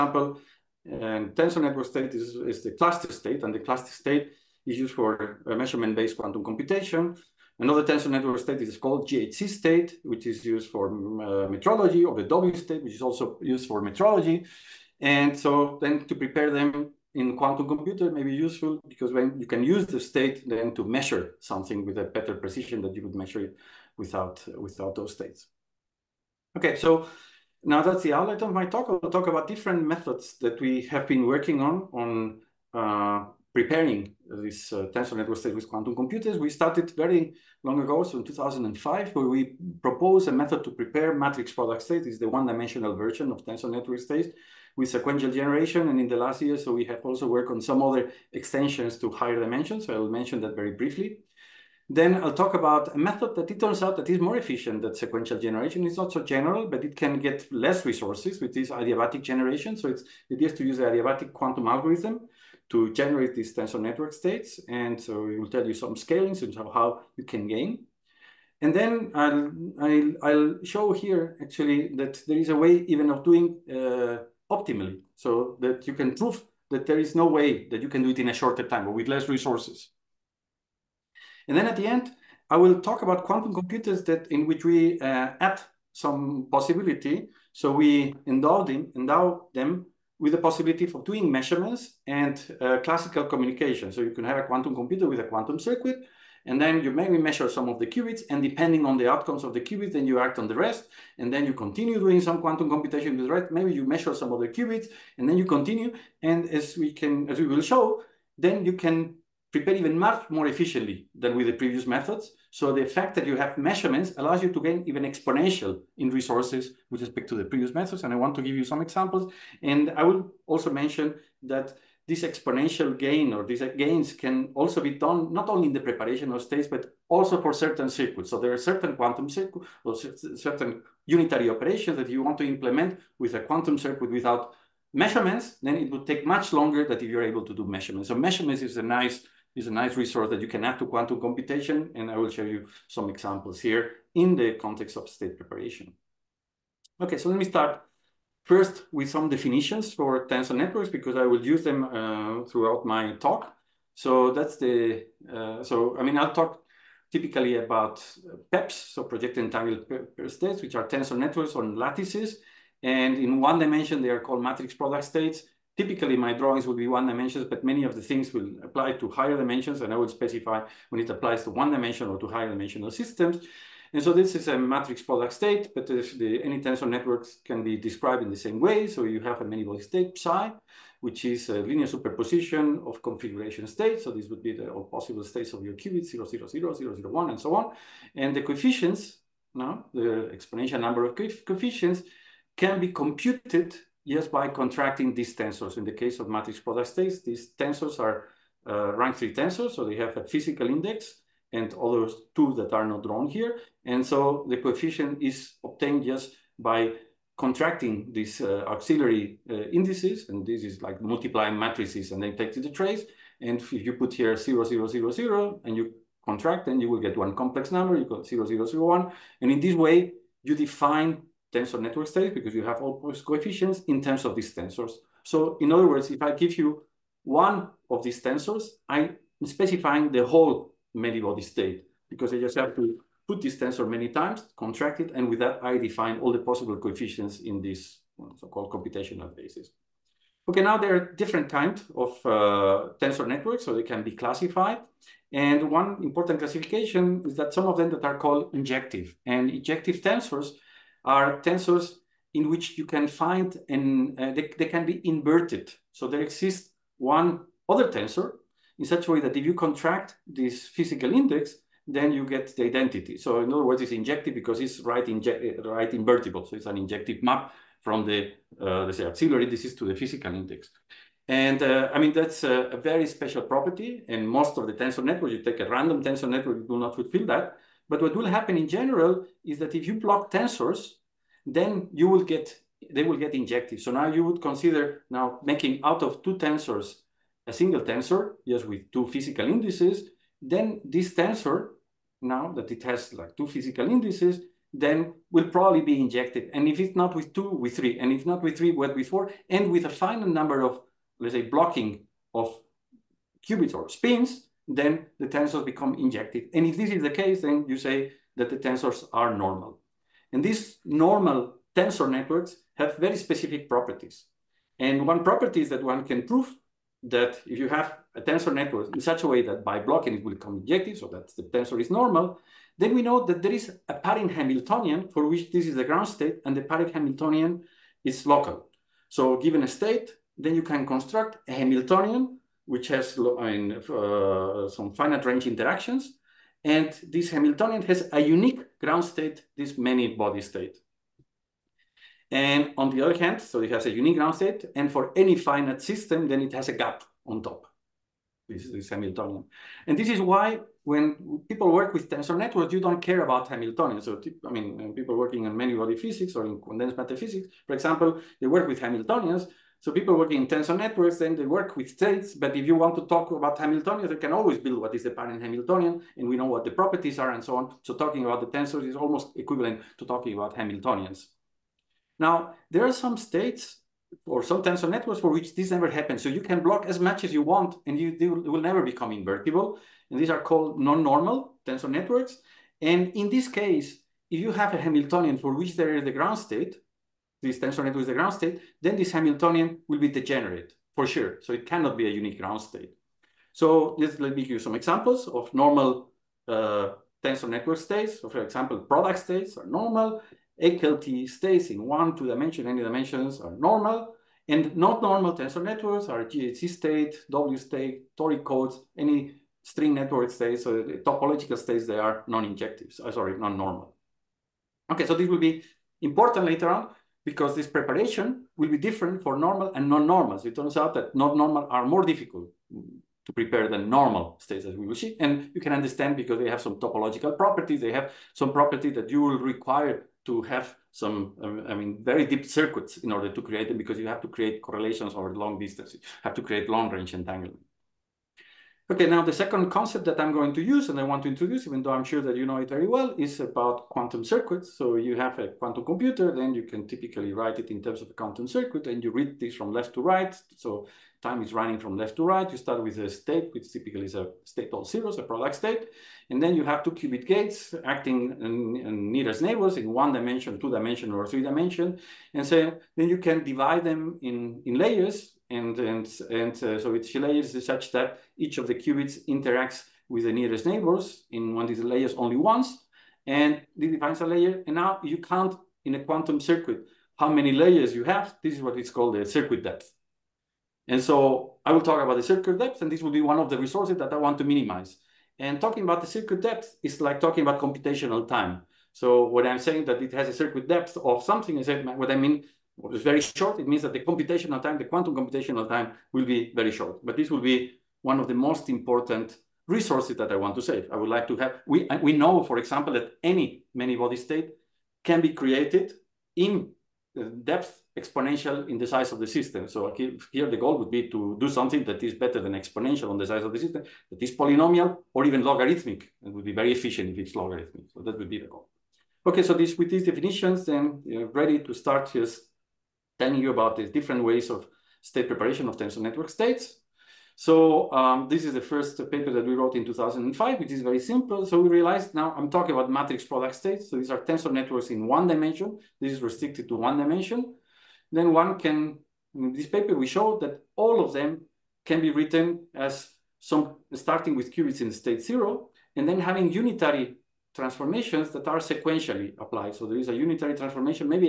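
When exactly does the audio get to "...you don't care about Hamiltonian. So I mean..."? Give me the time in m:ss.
5:52.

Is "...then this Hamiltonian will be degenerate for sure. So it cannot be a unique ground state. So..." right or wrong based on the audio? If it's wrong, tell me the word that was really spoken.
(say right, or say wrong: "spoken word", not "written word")
right.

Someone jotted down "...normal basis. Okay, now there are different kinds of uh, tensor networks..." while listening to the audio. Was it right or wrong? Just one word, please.
wrong.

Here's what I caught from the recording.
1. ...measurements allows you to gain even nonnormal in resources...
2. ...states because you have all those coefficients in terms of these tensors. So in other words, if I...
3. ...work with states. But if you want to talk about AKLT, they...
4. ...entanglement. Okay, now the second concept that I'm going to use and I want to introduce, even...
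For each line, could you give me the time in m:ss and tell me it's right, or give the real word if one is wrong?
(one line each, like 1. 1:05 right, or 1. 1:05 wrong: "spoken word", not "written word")
1. 1:53 wrong: "exponential", not "nonnormal"
2. 3:42 right
3. 6:01 wrong: "Hamiltonians", not "AKLT"
4. 7:17 right.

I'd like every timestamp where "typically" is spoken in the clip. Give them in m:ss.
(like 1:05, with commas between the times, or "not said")
2:37, 2:45, 7:26, 7:33.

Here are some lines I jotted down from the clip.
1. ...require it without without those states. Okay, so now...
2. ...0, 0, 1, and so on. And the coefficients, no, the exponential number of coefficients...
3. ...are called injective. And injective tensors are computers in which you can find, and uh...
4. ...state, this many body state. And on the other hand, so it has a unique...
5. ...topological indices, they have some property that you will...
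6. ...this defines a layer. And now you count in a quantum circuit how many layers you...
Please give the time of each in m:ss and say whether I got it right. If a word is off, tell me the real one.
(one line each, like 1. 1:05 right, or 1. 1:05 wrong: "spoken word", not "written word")
1. 0:23 wrong: "measure", not "require"
2. 3:06 right
3. 4:08 wrong: "tensors", not "computers"
4. 5:39 right
5. 7:06 wrong: "properties", not "indices"
6. 7:53 right.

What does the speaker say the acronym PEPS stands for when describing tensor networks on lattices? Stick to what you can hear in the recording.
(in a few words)
Projected entangled states.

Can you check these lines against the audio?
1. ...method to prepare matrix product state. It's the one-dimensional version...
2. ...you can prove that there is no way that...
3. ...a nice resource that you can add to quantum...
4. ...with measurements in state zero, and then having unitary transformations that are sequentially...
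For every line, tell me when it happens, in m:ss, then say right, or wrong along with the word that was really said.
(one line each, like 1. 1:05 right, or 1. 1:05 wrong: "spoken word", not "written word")
1. 0:40 right
2. 1:15 right
3. 2:19 right
4. 9:04 wrong: "qubits", not "measurements".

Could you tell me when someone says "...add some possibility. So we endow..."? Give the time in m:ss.
1:25.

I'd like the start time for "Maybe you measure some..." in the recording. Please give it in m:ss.
1:43.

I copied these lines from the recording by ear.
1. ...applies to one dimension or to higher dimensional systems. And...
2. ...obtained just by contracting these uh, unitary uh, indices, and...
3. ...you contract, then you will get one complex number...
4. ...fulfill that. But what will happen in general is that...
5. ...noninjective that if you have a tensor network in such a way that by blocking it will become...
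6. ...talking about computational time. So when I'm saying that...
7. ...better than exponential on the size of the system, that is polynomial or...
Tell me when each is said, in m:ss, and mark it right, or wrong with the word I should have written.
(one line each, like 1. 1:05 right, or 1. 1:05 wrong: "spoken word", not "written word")
1. 2:51 right
2. 3:25 wrong: "auxiliary", not "unitary"
3. 3:35 right
4. 4:36 right
5. 5:16 wrong: "prove", not "noninjective"
6. 8:07 right
7. 8:32 right.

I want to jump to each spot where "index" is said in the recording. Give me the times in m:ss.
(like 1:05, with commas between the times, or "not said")
3:20, 4:21, 4:30.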